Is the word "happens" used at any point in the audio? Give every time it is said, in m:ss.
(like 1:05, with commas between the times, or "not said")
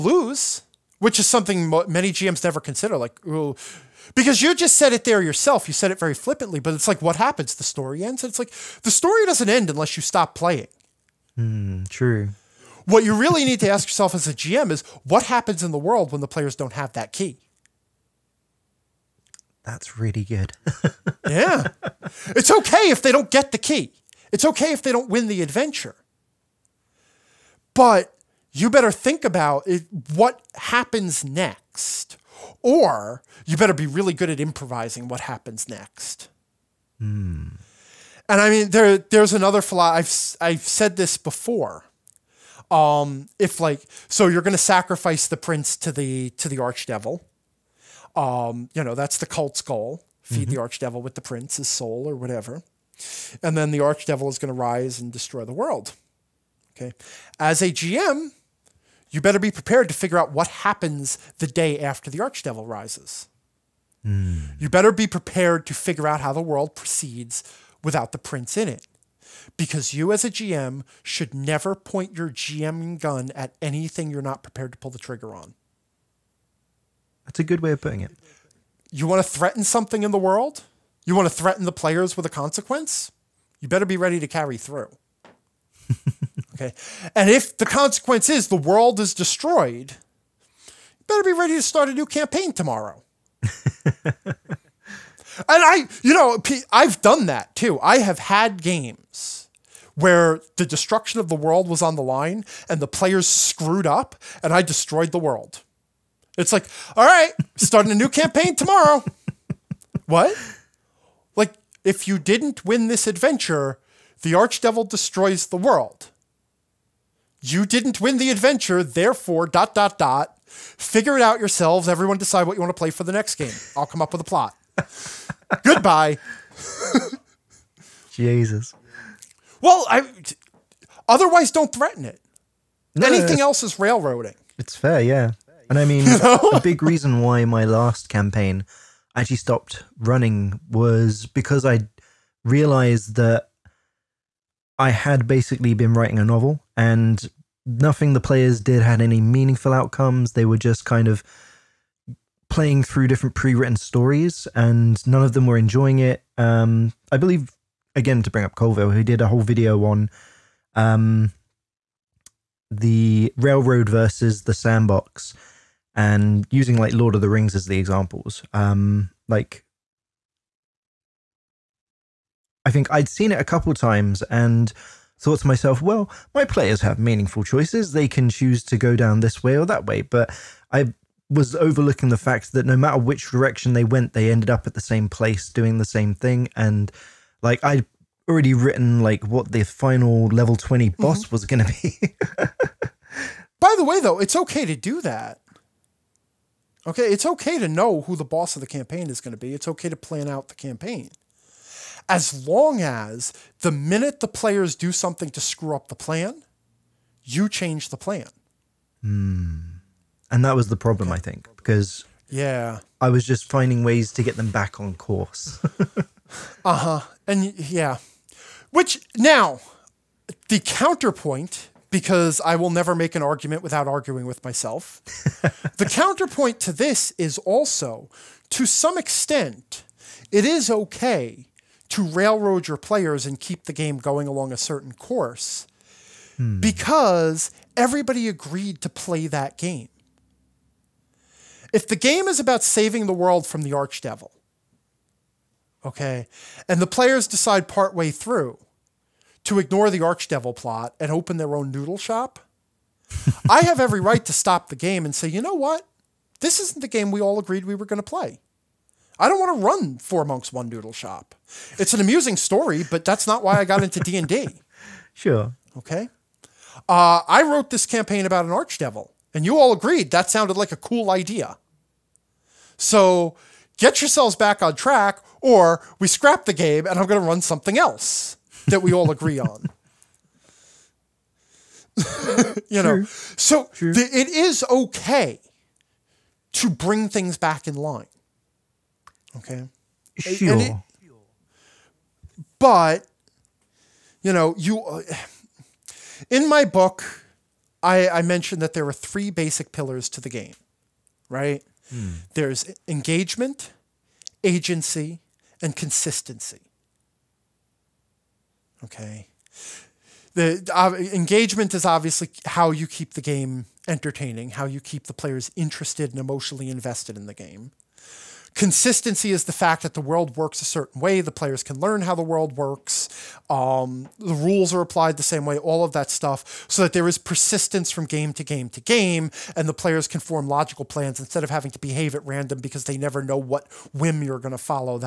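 0:07, 0:15, 0:30, 0:35, 1:00.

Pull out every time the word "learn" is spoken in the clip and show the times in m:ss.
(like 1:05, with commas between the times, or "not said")
5:21.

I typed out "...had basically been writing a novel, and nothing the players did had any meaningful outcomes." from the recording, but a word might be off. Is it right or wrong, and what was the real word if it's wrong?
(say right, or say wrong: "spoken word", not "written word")
right.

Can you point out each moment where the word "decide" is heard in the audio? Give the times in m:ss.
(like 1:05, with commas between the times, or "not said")
2:02, 4:07.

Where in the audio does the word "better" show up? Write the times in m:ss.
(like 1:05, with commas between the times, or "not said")
0:28, 0:33, 0:59, 1:04, 1:23, 1:31.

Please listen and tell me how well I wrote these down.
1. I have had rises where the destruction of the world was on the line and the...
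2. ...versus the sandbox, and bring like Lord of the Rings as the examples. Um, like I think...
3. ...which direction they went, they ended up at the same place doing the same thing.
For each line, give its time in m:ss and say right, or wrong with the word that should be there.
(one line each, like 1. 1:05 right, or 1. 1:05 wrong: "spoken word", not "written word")
1. 1:37 wrong: "games", not "rises"
2. 2:43 wrong: "using", not "bring"
3. 3:02 right.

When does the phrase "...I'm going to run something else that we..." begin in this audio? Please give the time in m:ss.
4:36.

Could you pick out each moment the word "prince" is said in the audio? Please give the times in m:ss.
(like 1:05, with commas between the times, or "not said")
0:45, 0:51, 1:08.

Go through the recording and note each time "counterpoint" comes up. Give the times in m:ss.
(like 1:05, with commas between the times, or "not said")
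3:40, 3:45.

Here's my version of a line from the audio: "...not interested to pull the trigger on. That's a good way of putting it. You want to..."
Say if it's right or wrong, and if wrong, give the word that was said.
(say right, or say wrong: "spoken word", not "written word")
wrong: "prepared", not "interested".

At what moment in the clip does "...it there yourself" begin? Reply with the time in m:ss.
0:04.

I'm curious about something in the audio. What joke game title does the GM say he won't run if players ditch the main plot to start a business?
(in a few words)
Four Monks One Noodle Shop.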